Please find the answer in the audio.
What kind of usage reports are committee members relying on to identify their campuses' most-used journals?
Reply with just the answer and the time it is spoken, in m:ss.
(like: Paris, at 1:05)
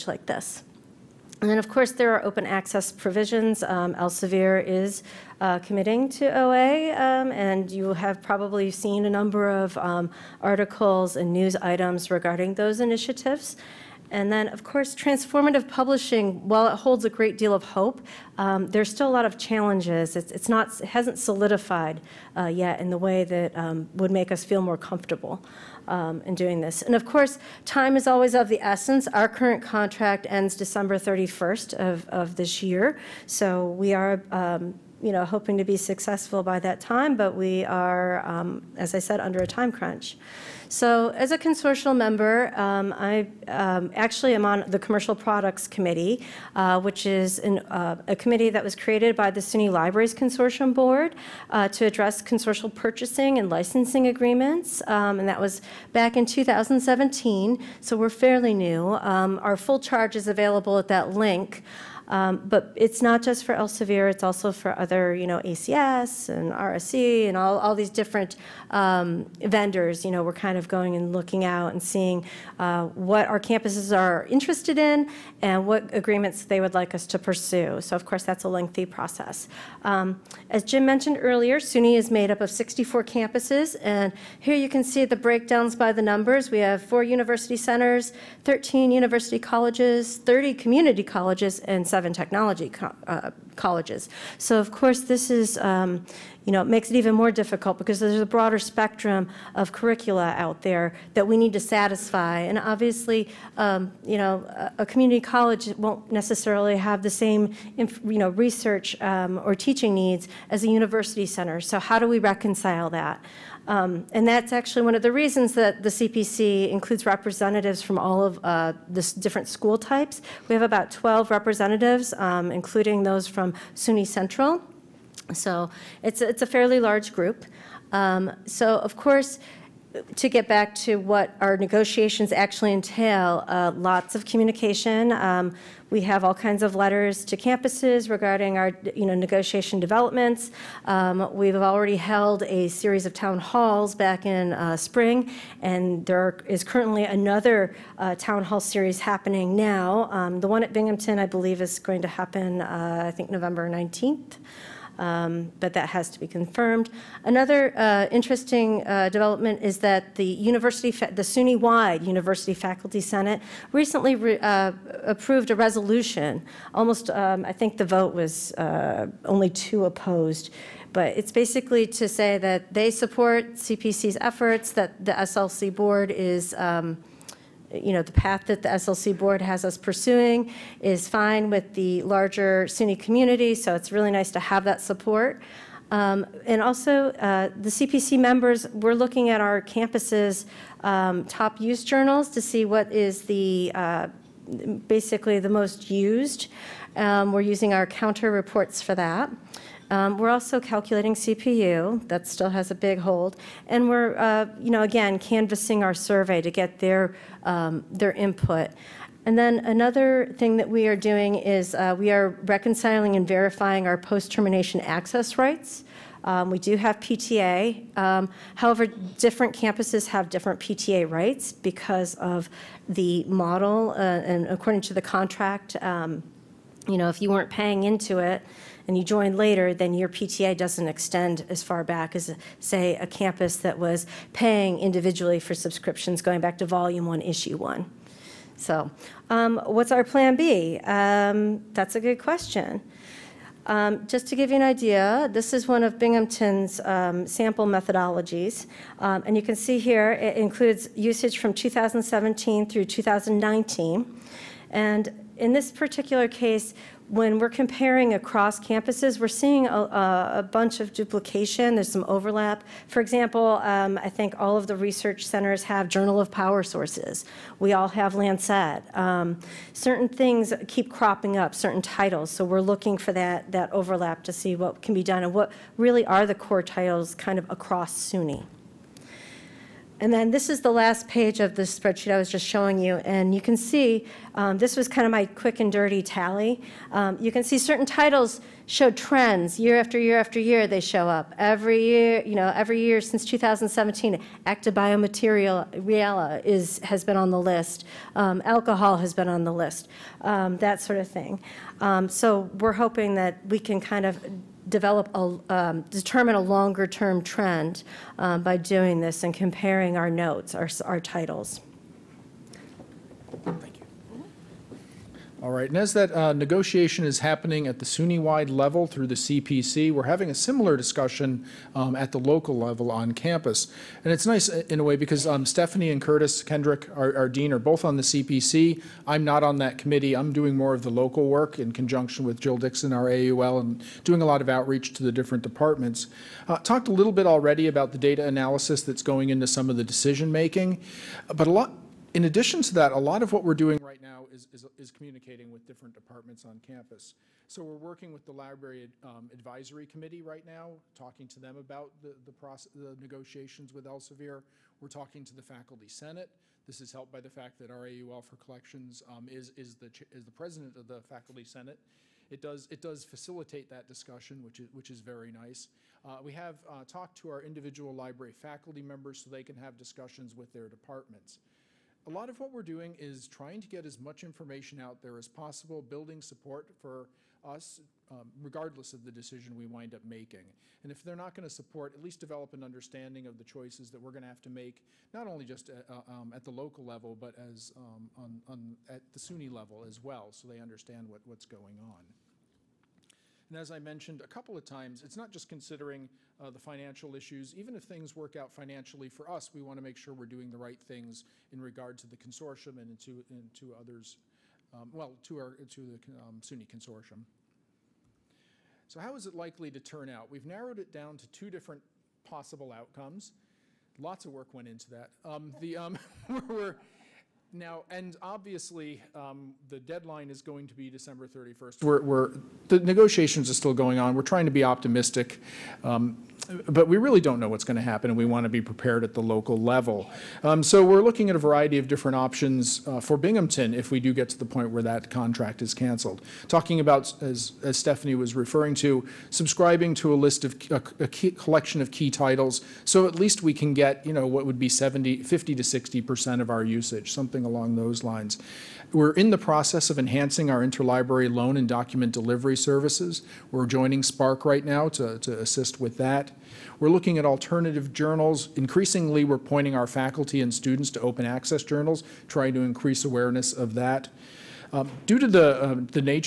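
COUNTER reports, at 3:17.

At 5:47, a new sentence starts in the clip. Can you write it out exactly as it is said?
So we're working with the Library um, Advisory Committee right now, talking to them about the, the, process, the negotiations with Elsevier.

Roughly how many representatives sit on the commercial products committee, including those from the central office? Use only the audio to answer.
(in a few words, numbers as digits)
12.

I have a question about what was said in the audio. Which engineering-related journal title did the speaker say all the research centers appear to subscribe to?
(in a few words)
Journal of Power Sources.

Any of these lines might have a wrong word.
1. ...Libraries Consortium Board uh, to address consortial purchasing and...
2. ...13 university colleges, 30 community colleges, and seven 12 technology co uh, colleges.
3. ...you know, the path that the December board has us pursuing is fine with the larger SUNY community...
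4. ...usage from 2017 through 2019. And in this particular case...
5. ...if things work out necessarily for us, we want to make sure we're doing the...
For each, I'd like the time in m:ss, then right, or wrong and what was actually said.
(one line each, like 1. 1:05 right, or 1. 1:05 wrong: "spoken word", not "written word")
1. 0:49 right
2. 1:28 wrong: "11", not "12"
3. 2:57 wrong: "SLC", not "December"
4. 4:10 right
5. 6:37 wrong: "financially", not "necessarily".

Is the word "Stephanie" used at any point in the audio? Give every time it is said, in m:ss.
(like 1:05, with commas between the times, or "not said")
5:25, 7:17.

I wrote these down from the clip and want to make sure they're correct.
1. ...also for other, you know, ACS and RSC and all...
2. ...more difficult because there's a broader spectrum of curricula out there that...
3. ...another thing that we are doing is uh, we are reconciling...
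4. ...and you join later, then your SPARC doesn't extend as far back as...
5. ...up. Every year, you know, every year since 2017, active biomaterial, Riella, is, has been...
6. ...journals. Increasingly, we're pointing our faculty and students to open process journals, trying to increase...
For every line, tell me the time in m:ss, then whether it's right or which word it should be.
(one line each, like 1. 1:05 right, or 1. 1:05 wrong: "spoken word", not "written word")
1. 1:04 right
2. 1:37 right
3. 3:29 right
4. 3:48 wrong: "PTA", not "SPARC"
5. 4:51 right
6. 7:37 wrong: "access", not "process".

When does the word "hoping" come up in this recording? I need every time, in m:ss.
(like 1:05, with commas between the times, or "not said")
0:35, 5:02.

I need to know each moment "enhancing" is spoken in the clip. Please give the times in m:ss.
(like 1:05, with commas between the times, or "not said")
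7:29.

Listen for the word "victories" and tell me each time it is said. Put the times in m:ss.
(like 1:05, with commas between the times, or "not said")
not said.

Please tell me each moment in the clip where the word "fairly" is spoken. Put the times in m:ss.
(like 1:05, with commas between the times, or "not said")
0:58, 2:06.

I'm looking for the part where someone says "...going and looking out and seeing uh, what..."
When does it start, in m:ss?
1:10.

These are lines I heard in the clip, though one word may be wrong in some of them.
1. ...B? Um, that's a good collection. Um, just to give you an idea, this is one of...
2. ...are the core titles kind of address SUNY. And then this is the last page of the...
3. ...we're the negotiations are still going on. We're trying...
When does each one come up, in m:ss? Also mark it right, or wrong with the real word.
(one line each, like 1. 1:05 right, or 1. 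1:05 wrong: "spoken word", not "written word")
1. 4:00 wrong: "question", not "collection"
2. 4:36 wrong: "across", not "address"
3. 7:02 right.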